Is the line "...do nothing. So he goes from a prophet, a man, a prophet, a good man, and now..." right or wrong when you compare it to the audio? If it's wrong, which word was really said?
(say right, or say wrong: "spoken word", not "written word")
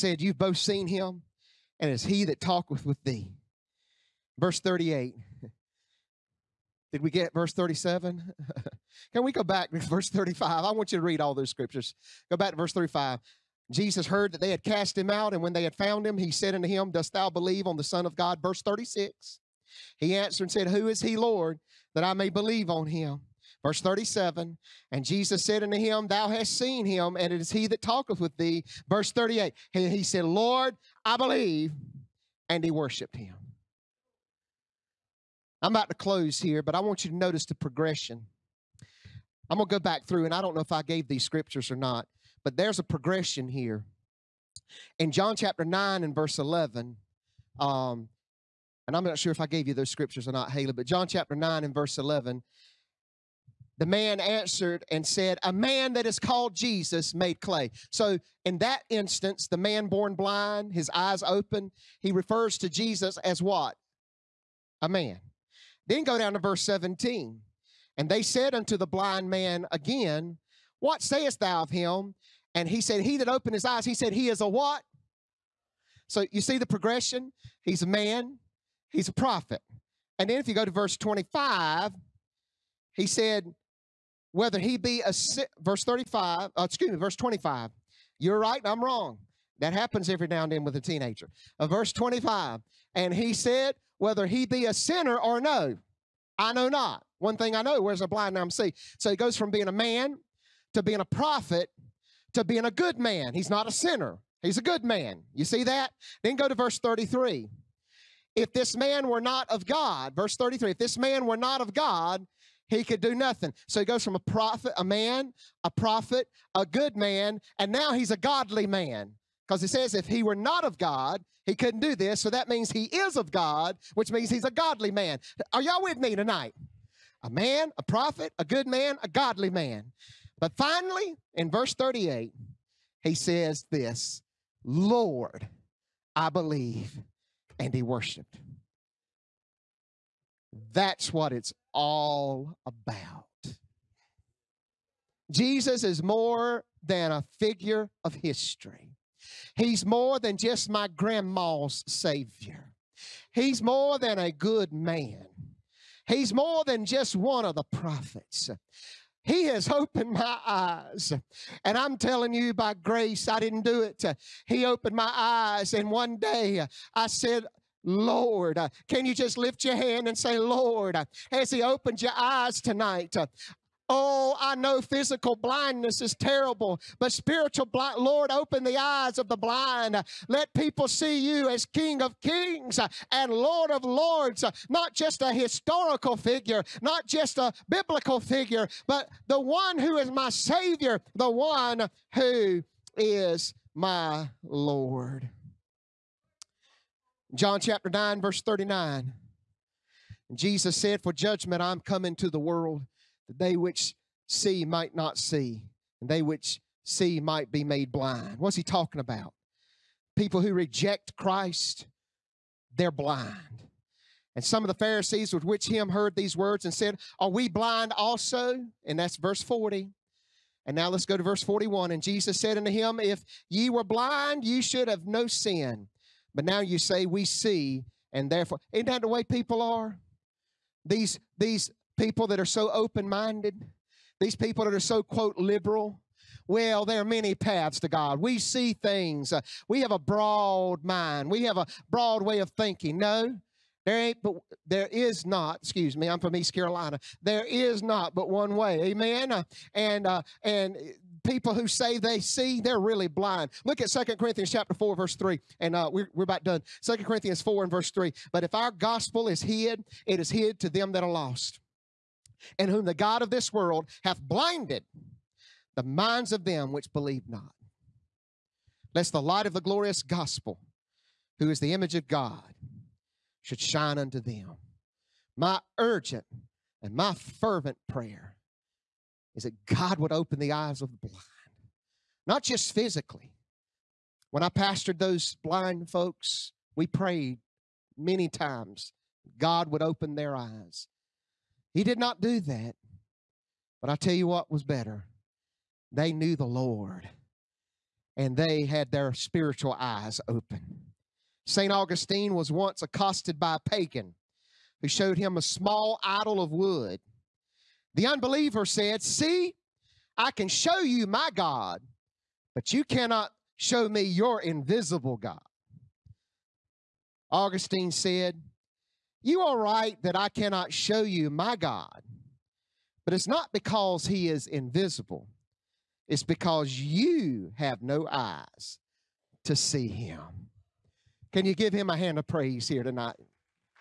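right.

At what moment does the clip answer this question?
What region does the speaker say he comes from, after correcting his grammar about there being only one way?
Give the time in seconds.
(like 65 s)
246 s.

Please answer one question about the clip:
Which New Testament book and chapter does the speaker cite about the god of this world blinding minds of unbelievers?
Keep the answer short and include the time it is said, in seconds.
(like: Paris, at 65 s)
Second Corinthians 4, at 253 s.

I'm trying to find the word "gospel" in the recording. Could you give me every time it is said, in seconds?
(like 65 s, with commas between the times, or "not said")
258 s, 270 s.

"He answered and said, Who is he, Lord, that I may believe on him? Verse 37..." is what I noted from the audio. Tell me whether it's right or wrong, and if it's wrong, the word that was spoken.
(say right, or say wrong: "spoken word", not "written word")
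right.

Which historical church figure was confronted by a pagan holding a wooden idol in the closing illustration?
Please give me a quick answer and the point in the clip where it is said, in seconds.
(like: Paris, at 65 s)
St. Augustine, at 301 s.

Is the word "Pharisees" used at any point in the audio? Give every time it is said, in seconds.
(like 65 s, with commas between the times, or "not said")
214 s.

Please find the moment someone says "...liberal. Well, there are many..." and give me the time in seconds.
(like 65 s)
235 s.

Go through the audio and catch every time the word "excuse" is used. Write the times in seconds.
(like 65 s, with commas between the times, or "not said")
86 s, 245 s.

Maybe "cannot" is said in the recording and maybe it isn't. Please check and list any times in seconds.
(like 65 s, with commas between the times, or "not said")
312 s, 320 s.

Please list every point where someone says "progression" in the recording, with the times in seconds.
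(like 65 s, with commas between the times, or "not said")
37 s, 42 s, 76 s.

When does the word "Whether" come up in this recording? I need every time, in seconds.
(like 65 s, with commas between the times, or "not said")
84 s, 93 s.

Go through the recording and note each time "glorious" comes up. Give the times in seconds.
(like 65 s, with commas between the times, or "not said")
269 s.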